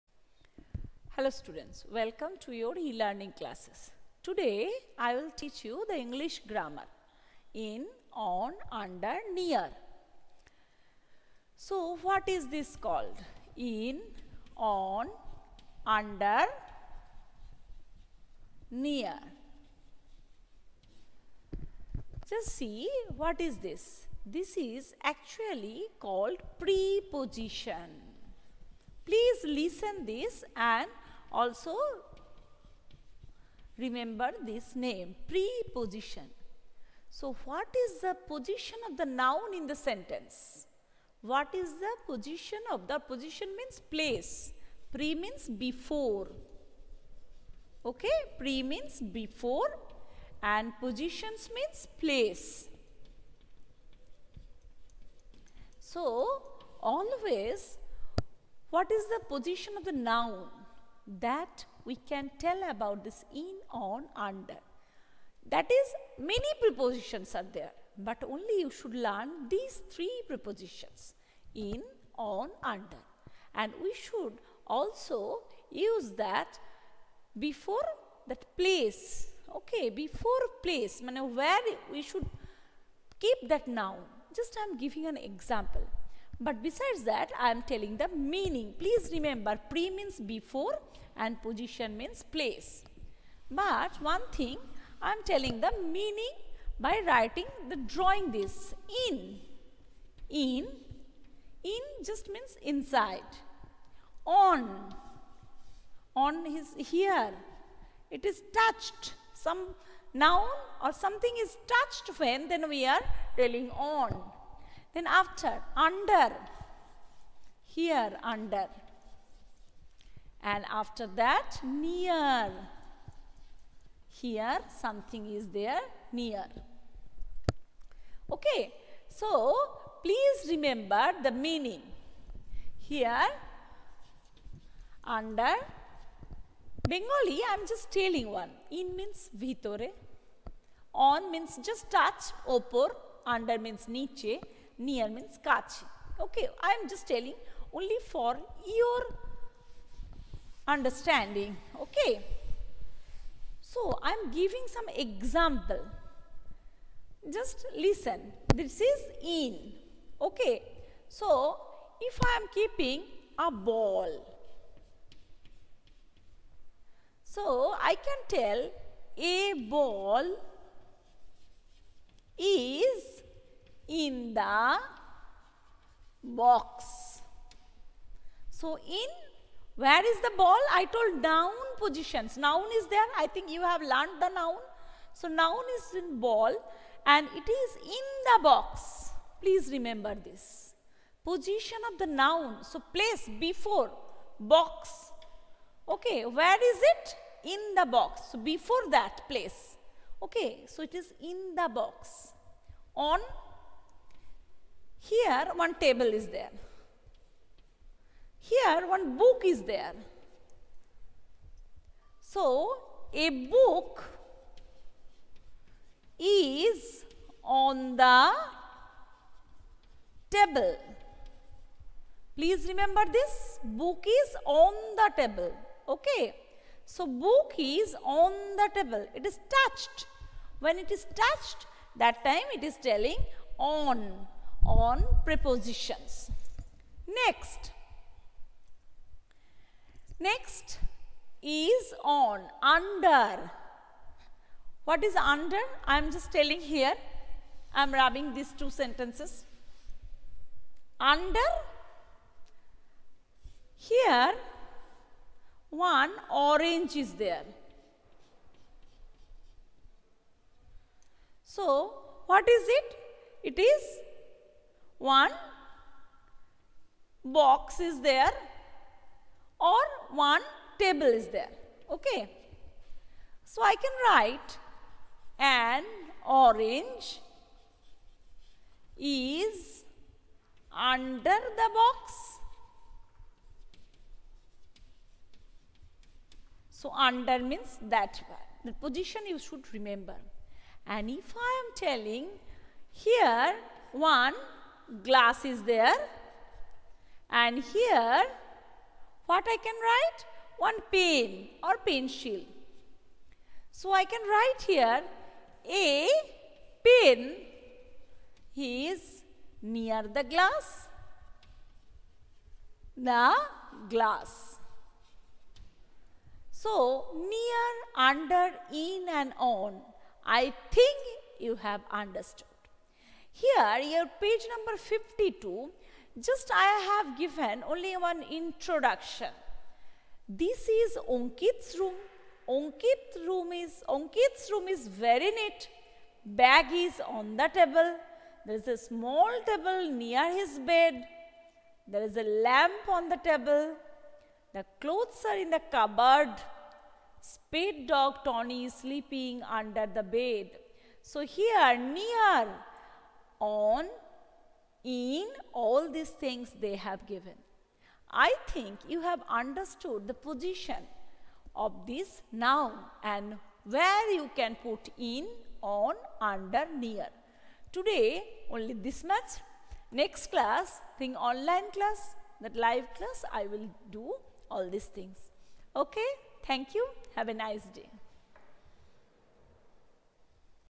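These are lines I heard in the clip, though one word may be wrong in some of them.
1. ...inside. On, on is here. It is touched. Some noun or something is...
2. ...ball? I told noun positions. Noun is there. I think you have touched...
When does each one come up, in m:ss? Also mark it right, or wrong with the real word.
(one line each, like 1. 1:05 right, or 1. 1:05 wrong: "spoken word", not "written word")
1. 1:42 right
2. 3:00 wrong: "learned", not "touched".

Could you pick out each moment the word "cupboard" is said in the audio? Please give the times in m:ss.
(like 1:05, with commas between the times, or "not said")
5:45.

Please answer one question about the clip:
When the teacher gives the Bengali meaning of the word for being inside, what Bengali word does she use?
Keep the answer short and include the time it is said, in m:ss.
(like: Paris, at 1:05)
vitore, at 2:19.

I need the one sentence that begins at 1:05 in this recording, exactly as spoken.
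That is, many prepositions are there, but only you should learn these three prepositions in, on, under.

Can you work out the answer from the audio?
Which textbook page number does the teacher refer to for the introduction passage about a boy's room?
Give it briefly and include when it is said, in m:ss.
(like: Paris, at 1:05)
52, at 5:24.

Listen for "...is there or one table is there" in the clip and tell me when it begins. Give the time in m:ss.
4:27.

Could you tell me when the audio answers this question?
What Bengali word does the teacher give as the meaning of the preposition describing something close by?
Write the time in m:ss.
2:25.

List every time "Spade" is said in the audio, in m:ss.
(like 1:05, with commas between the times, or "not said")
5:47.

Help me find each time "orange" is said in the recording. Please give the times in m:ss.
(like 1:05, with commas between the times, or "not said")
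4:16, 4:36.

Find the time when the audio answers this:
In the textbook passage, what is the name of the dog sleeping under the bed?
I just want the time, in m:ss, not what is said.
5:48.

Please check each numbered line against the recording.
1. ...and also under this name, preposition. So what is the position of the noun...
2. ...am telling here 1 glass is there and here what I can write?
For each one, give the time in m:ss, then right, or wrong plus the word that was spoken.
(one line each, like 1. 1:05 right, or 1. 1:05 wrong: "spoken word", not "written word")
1. 0:30 wrong: "remember", not "under"
2. 4:51 right.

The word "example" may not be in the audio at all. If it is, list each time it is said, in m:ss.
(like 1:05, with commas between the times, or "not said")
1:25, 2:34.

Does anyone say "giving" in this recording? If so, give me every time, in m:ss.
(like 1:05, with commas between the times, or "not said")
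1:24, 2:34.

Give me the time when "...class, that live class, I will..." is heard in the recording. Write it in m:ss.
6:11.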